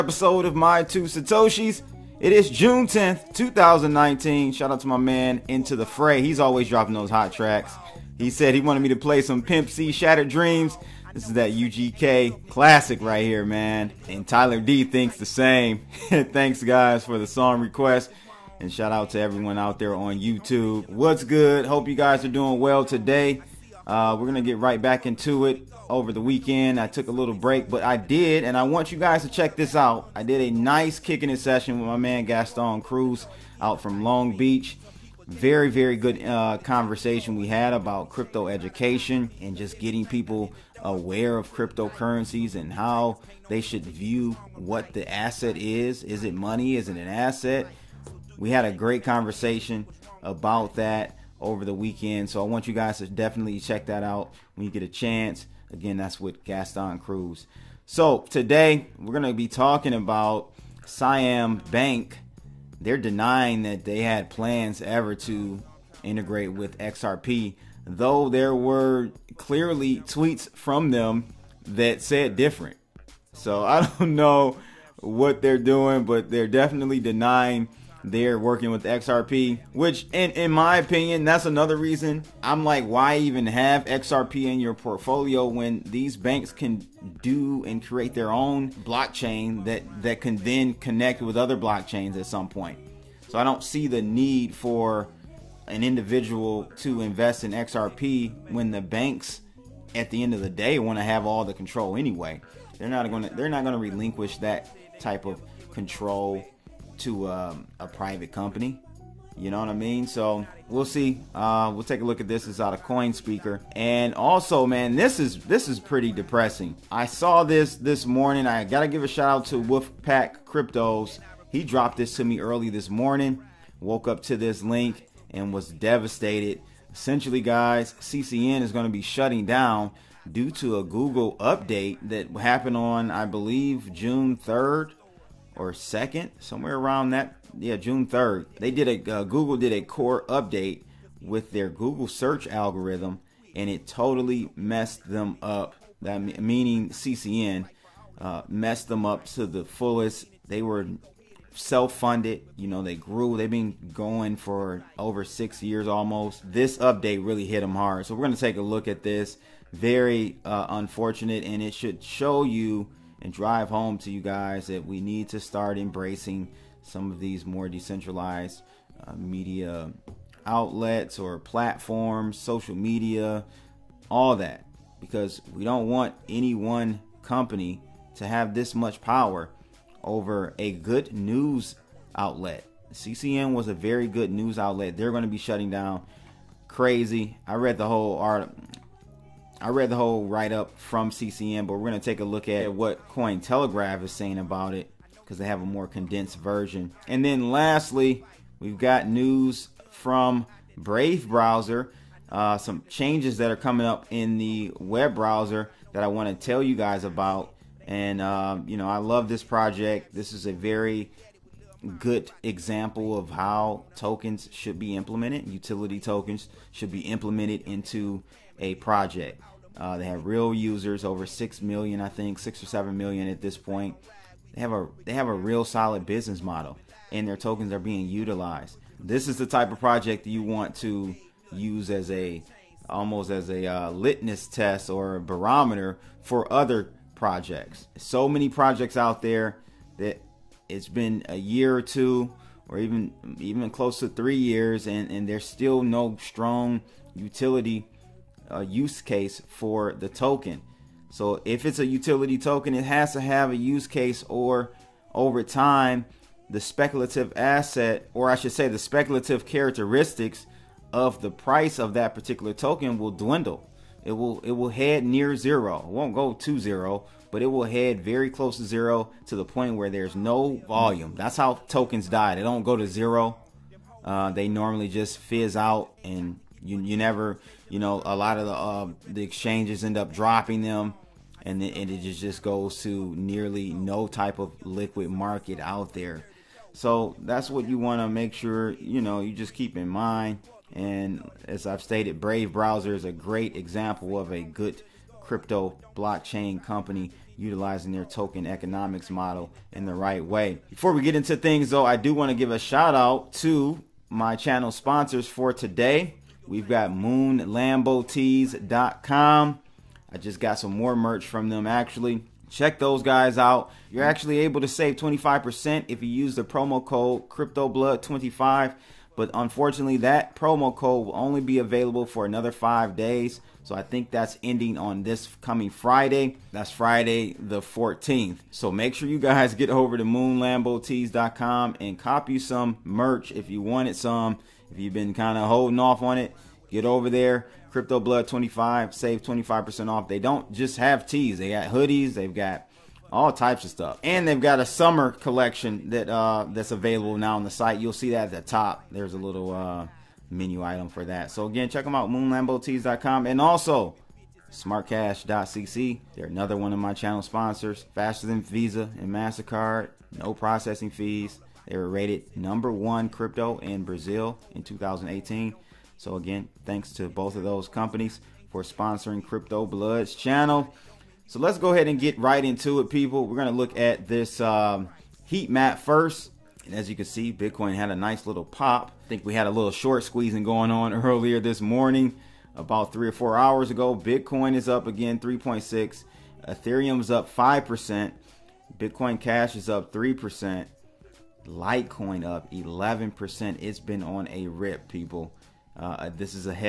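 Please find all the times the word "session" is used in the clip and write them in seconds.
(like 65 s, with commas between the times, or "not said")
31 s.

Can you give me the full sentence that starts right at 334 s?
If you've been kind of holding off on it, get over there.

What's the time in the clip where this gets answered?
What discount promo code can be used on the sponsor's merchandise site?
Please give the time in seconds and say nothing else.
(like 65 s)
317 s.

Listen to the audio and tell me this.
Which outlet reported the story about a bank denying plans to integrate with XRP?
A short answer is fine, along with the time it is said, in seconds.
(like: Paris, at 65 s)
Coin Speaker, at 112 s.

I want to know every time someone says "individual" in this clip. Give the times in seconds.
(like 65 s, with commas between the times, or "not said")
95 s.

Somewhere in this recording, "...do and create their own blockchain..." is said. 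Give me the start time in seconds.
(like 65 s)
87 s.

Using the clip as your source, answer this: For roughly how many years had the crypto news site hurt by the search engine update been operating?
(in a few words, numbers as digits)
6 years.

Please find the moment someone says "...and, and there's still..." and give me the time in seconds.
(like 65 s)
244 s.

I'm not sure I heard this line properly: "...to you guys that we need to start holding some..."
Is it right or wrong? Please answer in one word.
wrong.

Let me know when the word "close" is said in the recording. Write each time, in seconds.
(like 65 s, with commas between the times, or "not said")
243 s, 268 s.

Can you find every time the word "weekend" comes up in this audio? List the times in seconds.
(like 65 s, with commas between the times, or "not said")
26 s, 51 s.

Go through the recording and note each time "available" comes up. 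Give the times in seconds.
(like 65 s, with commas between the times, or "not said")
321 s, 346 s.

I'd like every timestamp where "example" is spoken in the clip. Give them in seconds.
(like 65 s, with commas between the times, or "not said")
212 s, 293 s.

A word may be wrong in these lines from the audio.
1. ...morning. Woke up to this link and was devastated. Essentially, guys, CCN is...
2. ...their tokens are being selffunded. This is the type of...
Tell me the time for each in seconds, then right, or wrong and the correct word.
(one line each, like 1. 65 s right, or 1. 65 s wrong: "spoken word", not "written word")
1. 122 s right
2. 227 s wrong: "utilized", not "selffunded".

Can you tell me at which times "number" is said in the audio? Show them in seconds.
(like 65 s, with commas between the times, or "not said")
362 s.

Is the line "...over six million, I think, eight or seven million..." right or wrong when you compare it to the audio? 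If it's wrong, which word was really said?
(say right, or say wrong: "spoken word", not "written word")
wrong: "six", not "eight".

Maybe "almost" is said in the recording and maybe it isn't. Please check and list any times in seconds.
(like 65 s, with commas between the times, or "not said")
155 s, 232 s.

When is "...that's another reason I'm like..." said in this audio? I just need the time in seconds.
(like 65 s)
81 s.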